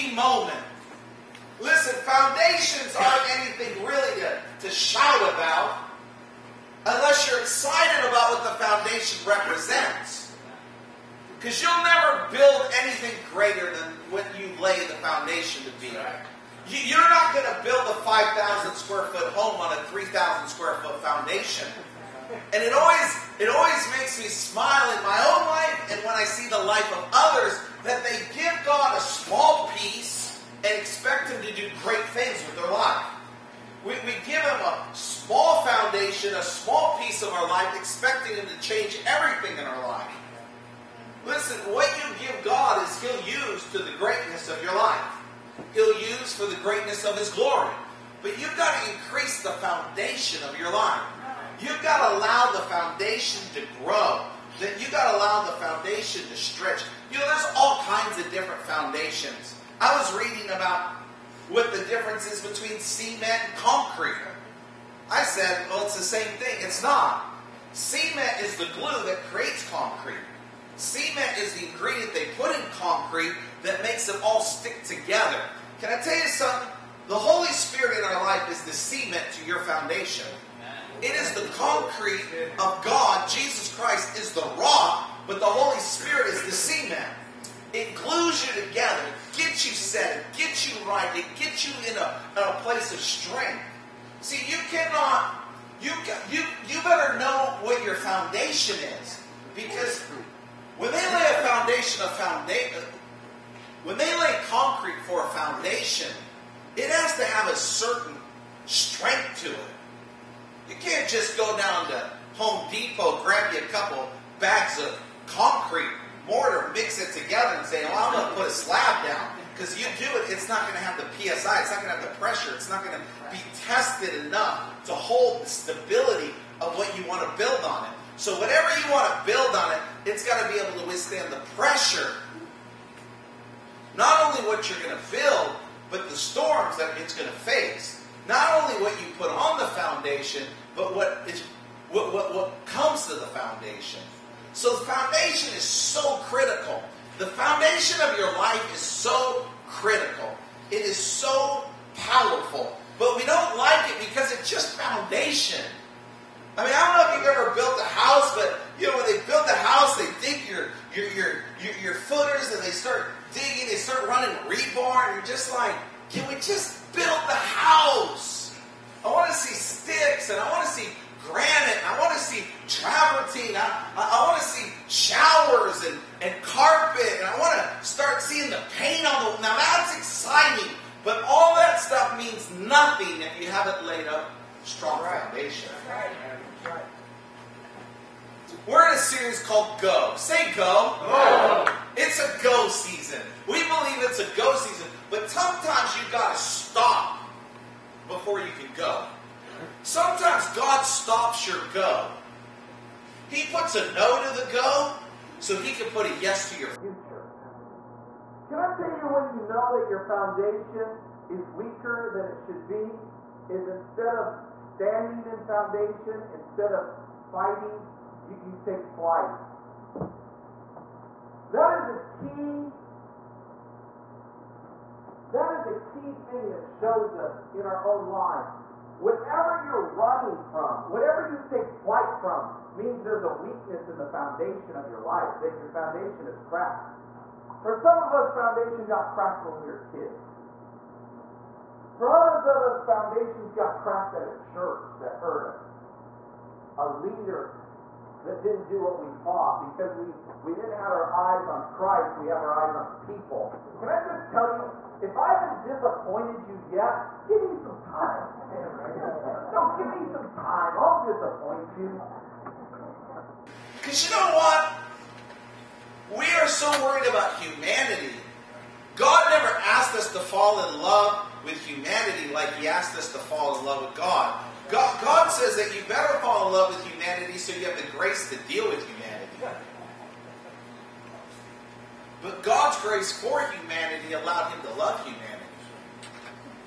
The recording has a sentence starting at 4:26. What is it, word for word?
We are so worried about humanity.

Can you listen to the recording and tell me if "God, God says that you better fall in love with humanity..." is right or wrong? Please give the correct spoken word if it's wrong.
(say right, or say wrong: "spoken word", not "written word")
right.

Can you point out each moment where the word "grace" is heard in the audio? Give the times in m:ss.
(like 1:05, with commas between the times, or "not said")
4:37, 4:42.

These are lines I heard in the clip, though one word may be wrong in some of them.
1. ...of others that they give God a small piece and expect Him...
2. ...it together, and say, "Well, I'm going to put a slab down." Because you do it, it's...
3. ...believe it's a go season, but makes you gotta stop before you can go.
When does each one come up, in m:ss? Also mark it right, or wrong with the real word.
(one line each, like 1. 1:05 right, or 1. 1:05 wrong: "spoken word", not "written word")
1. 0:26 right
2. 1:57 right
3. 3:13 wrong: "sometimes", not "makes".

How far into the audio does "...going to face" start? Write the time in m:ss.
2:17.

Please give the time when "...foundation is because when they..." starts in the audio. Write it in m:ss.
1:37.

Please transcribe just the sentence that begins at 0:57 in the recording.
You know, there's all kinds of different foundations.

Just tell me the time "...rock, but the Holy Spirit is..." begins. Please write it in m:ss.
1:24.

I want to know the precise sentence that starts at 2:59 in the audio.
Now that's exciting, but all that stuff means nothing if you haven't laid up strong right.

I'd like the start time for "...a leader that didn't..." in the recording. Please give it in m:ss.
4:06.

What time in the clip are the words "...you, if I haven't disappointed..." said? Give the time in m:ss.
4:14.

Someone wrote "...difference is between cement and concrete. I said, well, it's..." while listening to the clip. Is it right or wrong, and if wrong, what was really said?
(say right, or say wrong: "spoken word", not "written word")
right.